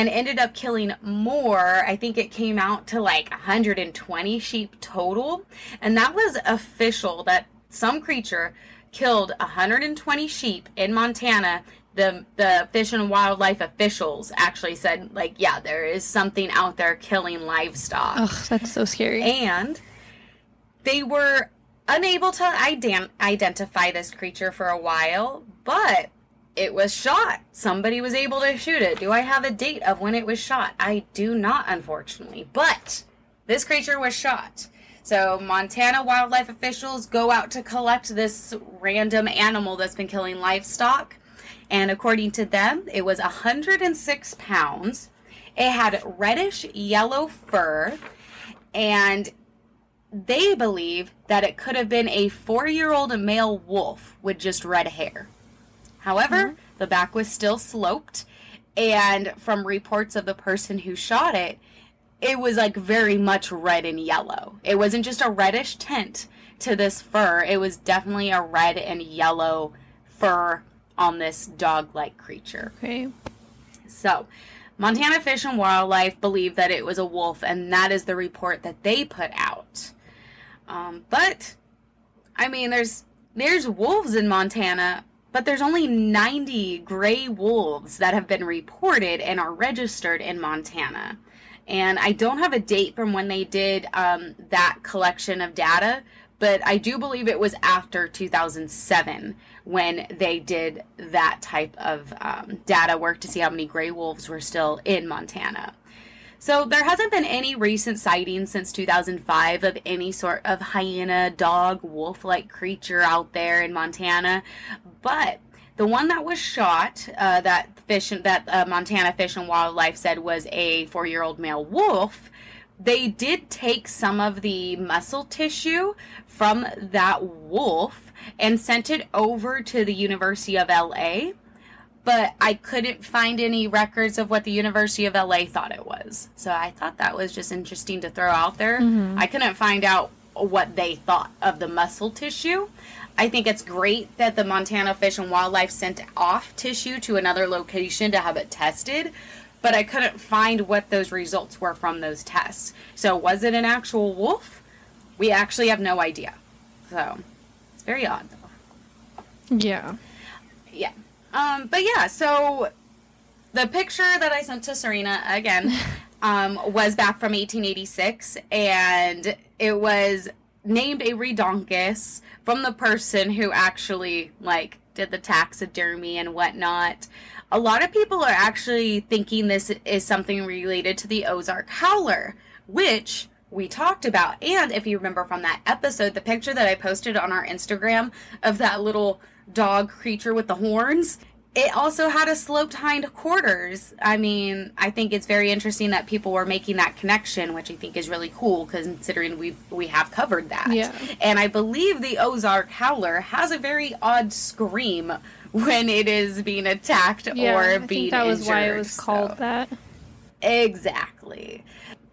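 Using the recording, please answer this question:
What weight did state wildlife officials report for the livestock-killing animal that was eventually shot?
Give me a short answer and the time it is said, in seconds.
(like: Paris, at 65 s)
106 pounds, at 43 s.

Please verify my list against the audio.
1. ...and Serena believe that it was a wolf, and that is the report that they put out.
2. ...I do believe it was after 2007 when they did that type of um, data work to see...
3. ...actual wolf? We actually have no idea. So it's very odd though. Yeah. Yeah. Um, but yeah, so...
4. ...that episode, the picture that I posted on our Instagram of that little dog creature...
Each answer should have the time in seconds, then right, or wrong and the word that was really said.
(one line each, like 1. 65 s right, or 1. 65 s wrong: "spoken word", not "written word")
1. 75 s wrong: "Wildlife", not "Serena"
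2. 96 s right
3. 153 s right
4. 185 s right.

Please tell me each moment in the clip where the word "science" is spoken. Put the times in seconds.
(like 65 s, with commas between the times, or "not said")
not said.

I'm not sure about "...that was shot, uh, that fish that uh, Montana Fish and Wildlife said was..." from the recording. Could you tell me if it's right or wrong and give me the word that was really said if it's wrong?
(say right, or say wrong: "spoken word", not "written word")
right.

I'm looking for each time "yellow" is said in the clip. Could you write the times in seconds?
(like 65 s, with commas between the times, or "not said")
46 s, 63 s, 69 s.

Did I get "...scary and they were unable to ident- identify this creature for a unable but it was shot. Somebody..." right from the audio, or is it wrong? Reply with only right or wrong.
wrong.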